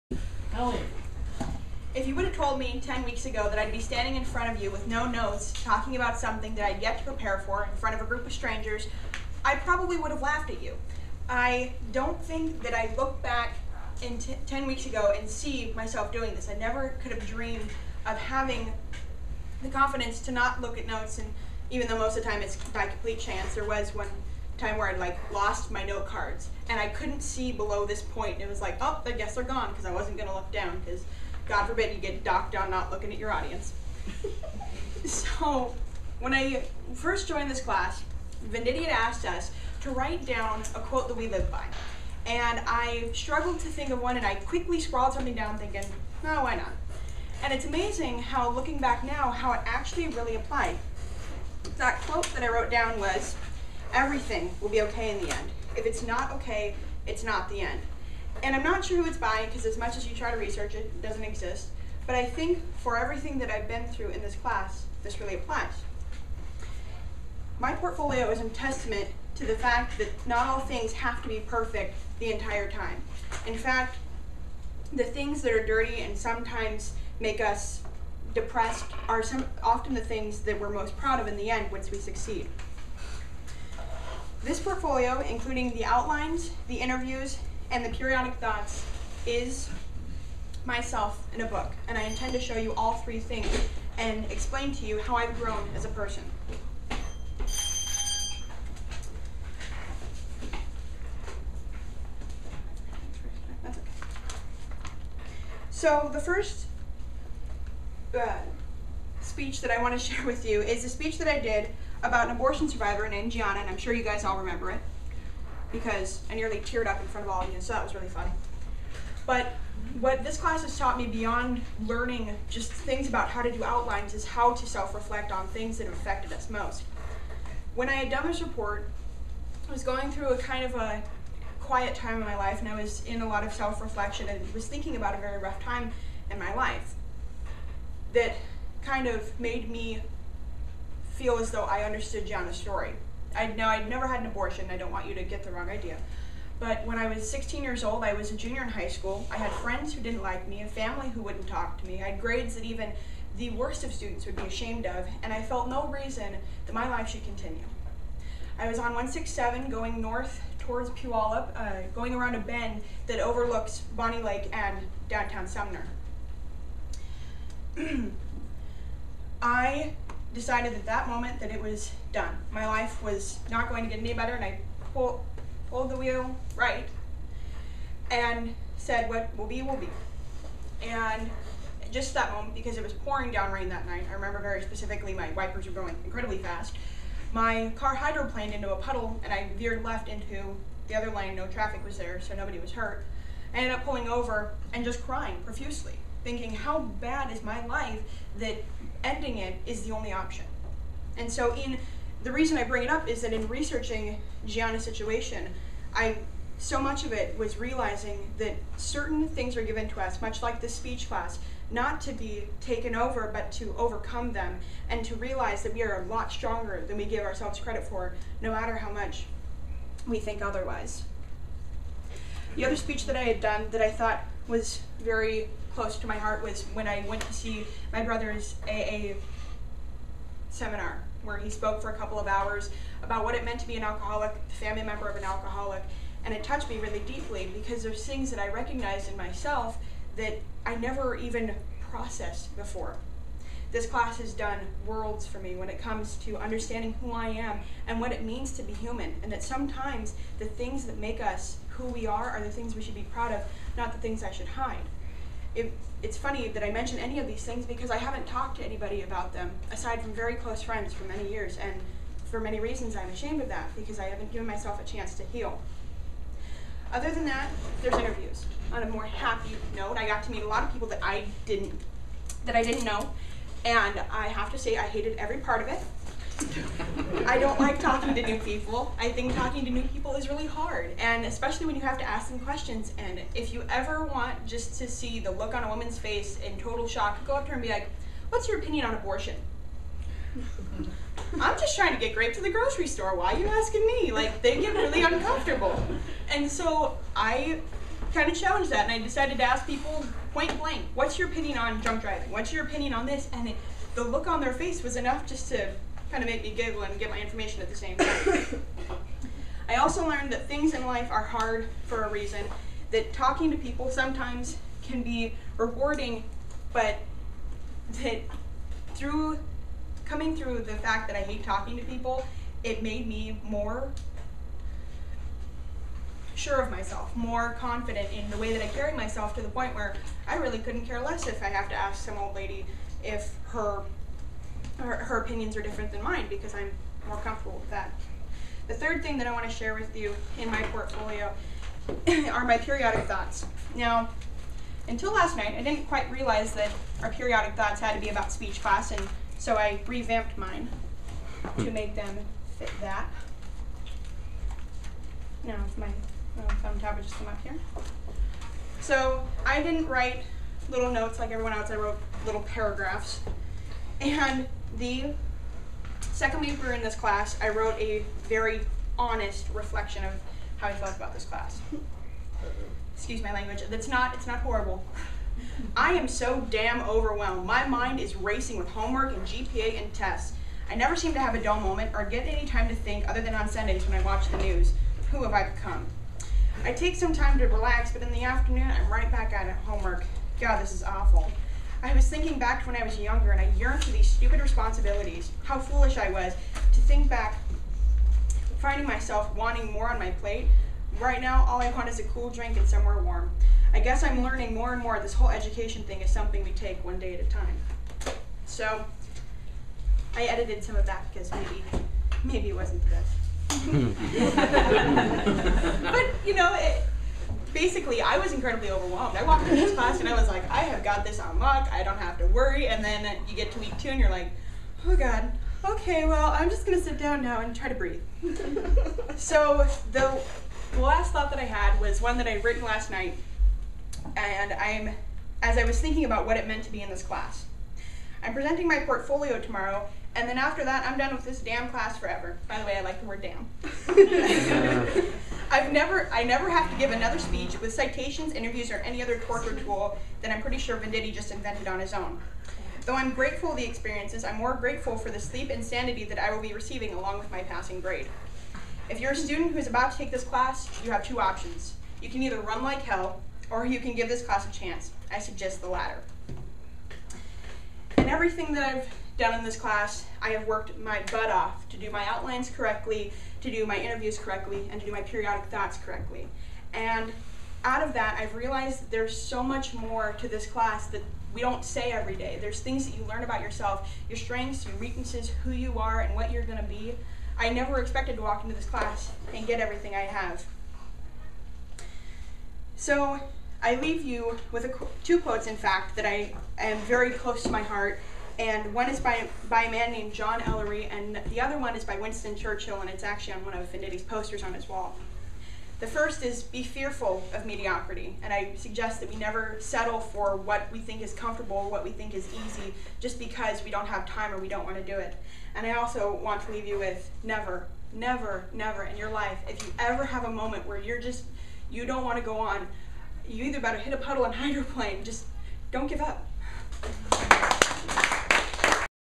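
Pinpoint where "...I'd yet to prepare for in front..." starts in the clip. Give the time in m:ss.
0:06.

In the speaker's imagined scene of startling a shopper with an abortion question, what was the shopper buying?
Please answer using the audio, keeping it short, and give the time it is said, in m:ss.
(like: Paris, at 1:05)
grapes, at 4:52.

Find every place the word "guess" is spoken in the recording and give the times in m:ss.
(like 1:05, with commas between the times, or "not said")
0:29, 6:43.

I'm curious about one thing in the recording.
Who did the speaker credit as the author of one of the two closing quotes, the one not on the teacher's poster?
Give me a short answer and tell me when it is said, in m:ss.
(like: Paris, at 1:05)
John Ellery, at 8:20.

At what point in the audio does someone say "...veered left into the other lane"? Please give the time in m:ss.
3:09.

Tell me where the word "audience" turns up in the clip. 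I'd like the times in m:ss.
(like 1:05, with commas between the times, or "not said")
0:33.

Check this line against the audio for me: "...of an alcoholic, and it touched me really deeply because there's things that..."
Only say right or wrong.
right.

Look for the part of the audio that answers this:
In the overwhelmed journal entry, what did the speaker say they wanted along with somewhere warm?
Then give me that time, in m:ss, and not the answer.
6:41.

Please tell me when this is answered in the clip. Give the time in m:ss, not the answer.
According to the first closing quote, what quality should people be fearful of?
8:27.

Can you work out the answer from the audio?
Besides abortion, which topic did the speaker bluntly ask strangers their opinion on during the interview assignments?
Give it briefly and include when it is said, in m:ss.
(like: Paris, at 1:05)
drunk driving, at 5:01.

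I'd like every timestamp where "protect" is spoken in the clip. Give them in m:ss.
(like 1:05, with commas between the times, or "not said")
not said.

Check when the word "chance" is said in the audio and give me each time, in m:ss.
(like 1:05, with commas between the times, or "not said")
0:23, 4:24, 7:44.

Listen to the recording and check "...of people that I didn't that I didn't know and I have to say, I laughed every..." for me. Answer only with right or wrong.
wrong.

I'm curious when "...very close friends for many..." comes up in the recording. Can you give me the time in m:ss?
4:20.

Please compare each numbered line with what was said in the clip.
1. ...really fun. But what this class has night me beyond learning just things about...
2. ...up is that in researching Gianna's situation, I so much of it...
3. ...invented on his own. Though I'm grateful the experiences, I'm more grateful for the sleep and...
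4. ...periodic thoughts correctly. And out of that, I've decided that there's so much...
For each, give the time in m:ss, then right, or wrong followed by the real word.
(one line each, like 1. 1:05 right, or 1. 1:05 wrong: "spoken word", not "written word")
1. 1:57 wrong: "taught", not "night"
2. 3:22 right
3. 7:31 right
4. 7:55 wrong: "realized", not "decided".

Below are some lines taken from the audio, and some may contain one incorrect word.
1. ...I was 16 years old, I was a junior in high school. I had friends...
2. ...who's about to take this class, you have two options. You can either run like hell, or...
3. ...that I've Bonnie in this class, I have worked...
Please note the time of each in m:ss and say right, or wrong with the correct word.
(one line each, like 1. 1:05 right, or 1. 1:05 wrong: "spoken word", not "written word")
1. 2:26 right
2. 7:39 right
3. 7:48 wrong: "Done", not "Bonnie".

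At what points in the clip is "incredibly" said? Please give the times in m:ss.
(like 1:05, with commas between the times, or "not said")
3:06, 6:58.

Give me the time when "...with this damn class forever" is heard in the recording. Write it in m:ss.
7:21.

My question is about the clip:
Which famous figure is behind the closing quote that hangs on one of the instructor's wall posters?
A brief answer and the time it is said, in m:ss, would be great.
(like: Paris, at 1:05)
Winston Churchill, at 8:21.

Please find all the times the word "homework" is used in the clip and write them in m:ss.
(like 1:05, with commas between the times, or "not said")
6:18, 6:29.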